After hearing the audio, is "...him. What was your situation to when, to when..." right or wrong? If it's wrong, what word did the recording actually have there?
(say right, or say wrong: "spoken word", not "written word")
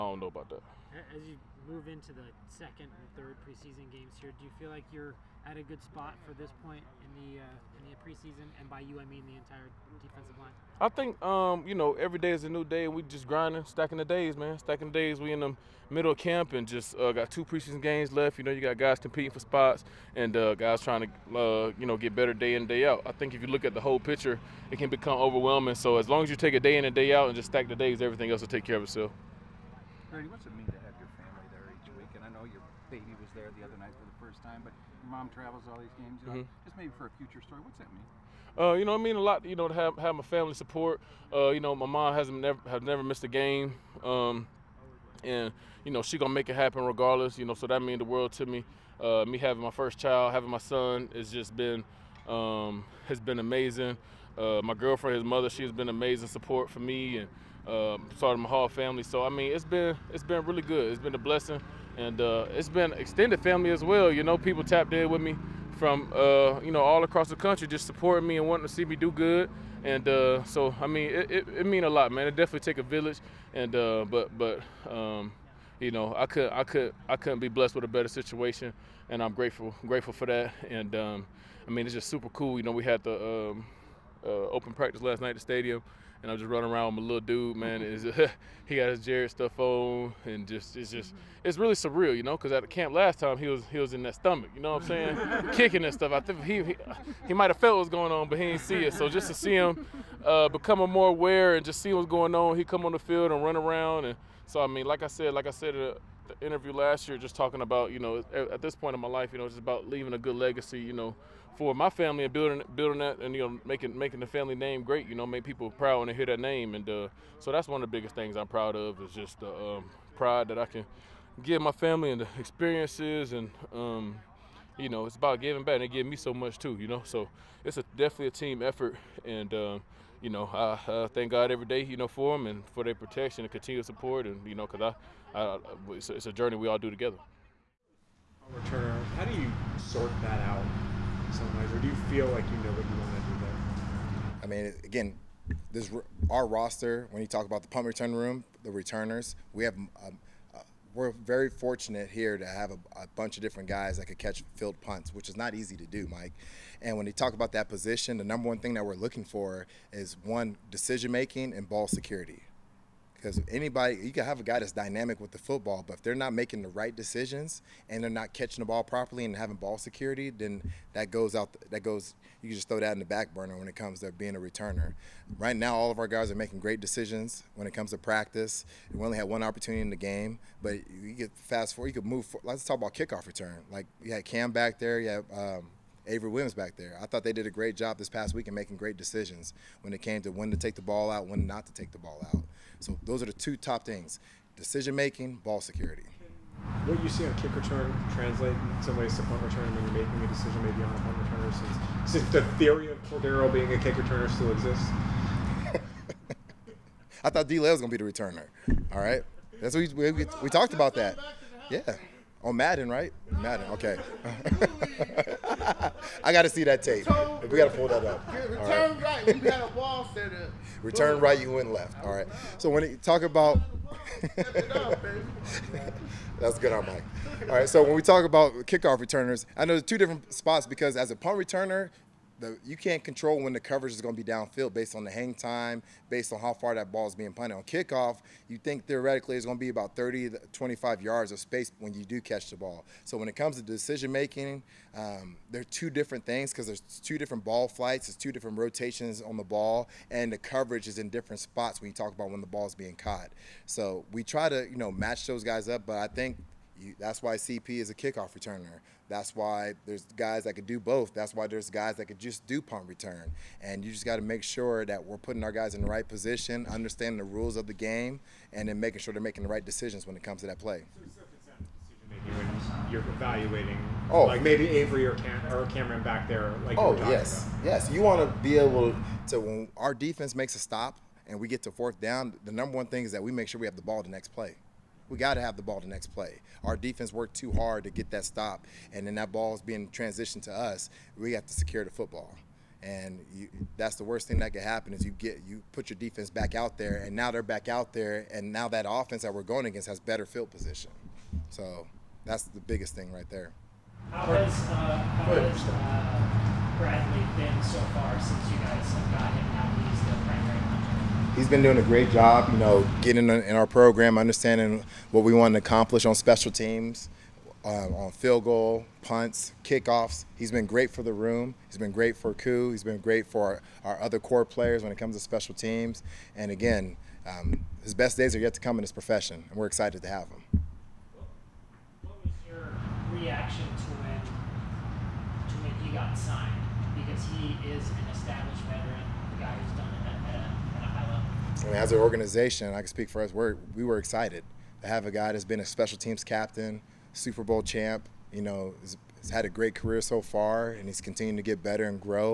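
wrong: "reaction", not "situation".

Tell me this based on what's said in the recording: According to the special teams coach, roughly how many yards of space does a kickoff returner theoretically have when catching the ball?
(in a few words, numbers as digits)
30 to 25 yards.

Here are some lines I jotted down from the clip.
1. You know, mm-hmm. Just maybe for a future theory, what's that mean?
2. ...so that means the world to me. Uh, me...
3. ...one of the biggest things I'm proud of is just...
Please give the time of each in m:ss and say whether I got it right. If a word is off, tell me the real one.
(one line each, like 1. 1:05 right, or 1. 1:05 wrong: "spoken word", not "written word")
1. 0:36 wrong: "story", not "theory"
2. 0:47 right
3. 1:57 right.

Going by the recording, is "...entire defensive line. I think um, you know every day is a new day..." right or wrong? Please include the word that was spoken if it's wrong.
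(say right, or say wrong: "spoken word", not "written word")
right.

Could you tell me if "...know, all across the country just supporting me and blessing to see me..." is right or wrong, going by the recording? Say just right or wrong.
wrong.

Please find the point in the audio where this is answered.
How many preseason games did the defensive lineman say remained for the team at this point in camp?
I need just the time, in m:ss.
0:17.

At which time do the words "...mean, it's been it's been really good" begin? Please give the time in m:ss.
0:59.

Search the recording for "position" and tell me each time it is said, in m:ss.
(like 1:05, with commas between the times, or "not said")
2:37, 4:26, 5:00.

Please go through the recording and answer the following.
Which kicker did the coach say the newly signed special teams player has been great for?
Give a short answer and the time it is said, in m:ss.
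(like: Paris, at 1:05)
Koo, at 5:22.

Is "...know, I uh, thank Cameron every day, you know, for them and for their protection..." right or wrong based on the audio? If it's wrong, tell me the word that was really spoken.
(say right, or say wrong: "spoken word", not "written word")
wrong: "God", not "Cameron".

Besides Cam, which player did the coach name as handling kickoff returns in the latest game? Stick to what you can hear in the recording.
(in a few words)
Avery Williams.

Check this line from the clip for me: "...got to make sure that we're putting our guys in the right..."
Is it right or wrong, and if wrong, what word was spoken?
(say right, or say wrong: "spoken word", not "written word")
right.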